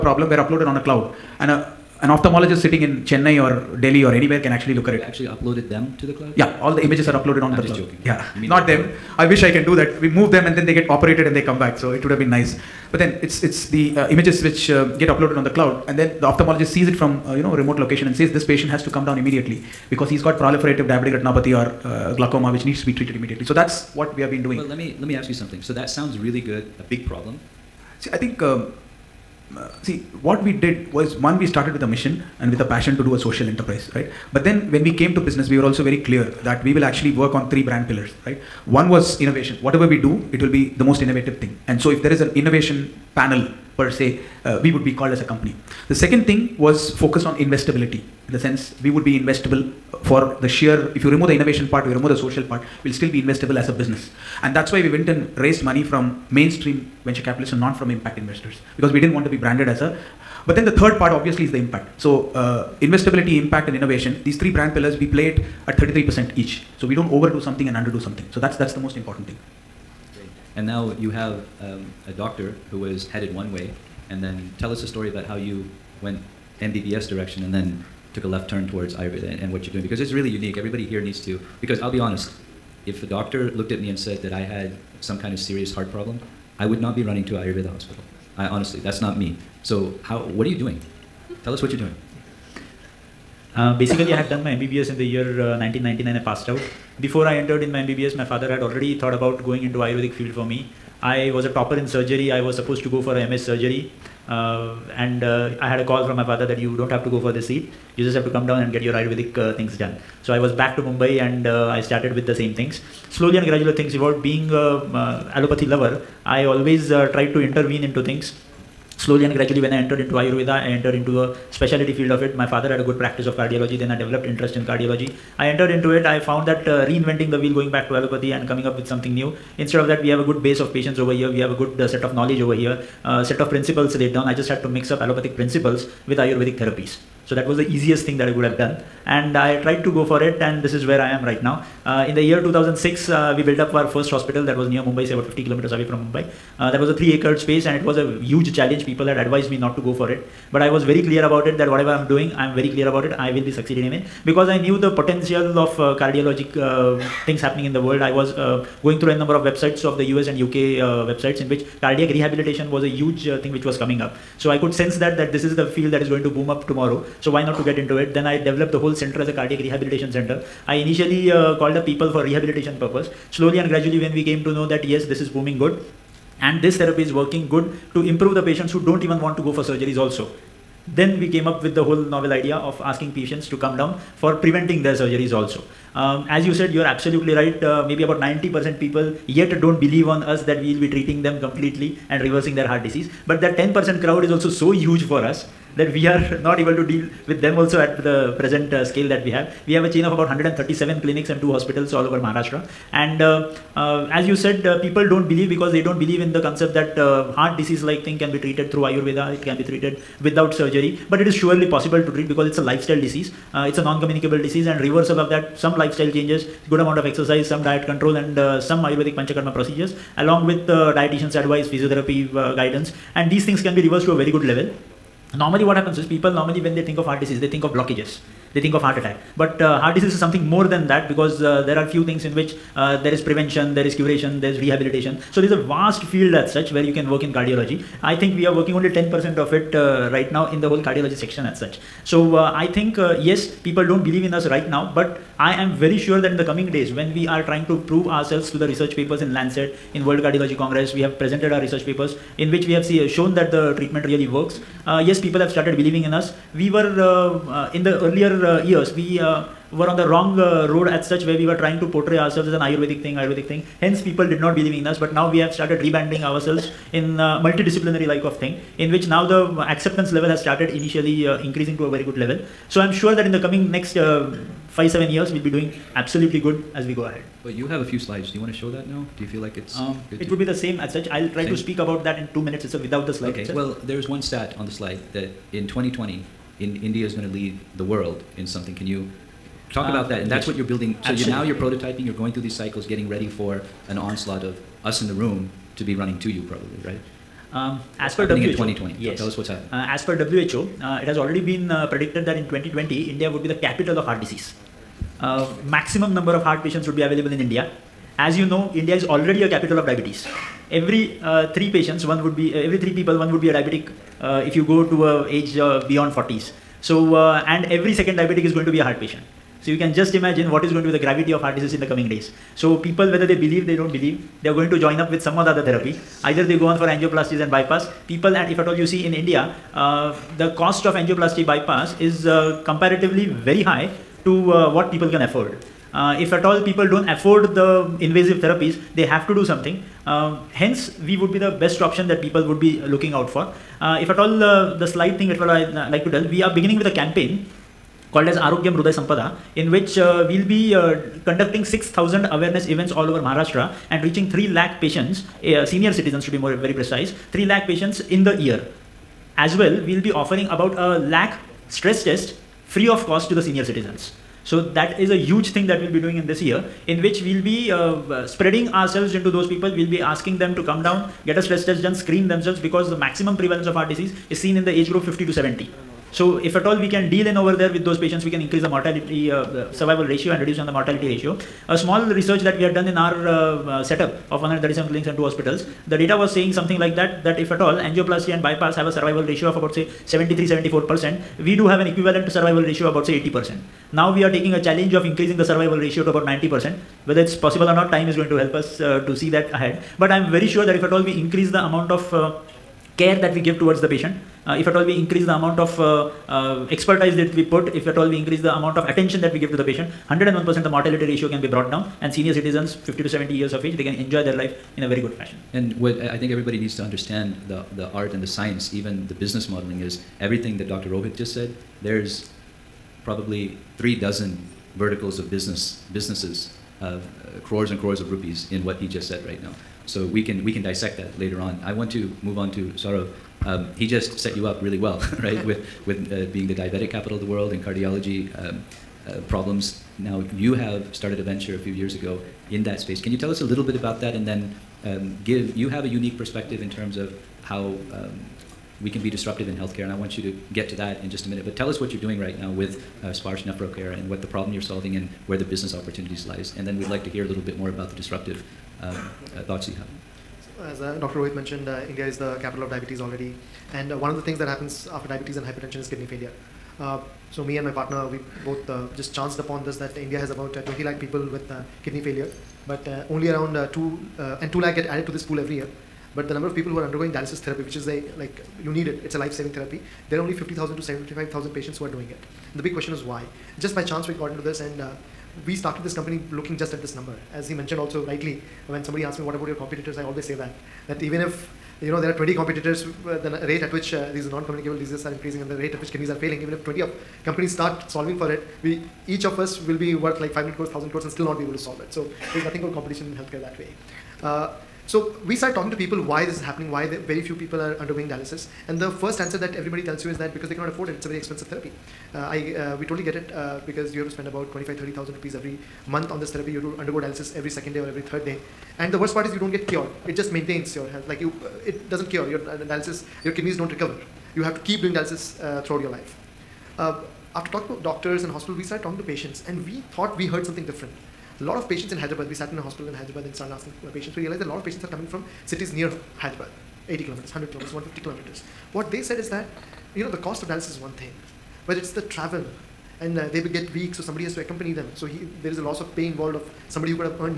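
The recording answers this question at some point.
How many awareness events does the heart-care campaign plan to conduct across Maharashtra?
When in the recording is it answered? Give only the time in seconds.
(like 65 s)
351 s.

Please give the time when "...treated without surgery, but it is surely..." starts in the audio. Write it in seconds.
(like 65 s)
209 s.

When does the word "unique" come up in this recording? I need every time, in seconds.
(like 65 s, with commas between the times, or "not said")
80 s, 445 s.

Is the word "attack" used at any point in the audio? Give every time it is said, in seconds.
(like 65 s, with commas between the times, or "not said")
228 s.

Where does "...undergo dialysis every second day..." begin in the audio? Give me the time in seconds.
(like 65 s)
516 s.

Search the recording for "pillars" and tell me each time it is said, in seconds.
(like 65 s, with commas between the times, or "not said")
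37 s, 64 s.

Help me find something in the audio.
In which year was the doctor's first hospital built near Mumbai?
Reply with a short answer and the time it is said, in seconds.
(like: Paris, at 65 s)
2006, at 142 s.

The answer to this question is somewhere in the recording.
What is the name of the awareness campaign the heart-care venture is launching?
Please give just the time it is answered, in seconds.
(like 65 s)
348 s.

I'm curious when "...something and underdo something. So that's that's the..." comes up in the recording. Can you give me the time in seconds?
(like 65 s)
67 s.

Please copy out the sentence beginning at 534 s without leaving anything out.
We realized that a lot of patients are coming from cities near Hyderabad, 80 kilometers, 100 kilometers, 150 kilometers.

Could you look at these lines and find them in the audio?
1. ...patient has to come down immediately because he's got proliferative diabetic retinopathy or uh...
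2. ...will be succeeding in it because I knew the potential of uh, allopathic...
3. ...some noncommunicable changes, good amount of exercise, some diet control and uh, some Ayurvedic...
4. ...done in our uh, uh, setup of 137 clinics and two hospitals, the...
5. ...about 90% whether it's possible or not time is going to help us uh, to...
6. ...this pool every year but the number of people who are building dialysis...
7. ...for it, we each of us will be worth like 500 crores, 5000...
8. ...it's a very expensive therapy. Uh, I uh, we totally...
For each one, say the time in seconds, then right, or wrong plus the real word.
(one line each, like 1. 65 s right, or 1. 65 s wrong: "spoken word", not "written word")
1. 18 s right
2. 153 s wrong: "cardiologic", not "allopathic"
3. 215 s wrong: "lifestyle", not "noncommunicable"
4. 382 s right
5. 396 s right
6. 475 s wrong: "undergoing", not "building"
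7. 498 s wrong: "1000", not "5000"
8. 510 s right.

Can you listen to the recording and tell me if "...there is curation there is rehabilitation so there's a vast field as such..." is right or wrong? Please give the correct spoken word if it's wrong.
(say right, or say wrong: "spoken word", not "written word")
right.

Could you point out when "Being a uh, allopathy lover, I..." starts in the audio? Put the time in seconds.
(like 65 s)
114 s.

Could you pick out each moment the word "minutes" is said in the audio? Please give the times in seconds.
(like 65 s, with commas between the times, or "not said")
282 s, 451 s.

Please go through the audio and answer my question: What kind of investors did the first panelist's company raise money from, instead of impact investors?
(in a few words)
mainstream venture capitalists.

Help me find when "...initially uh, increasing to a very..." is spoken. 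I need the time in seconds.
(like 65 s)
270 s.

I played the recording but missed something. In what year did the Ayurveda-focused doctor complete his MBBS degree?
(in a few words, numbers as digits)
1999.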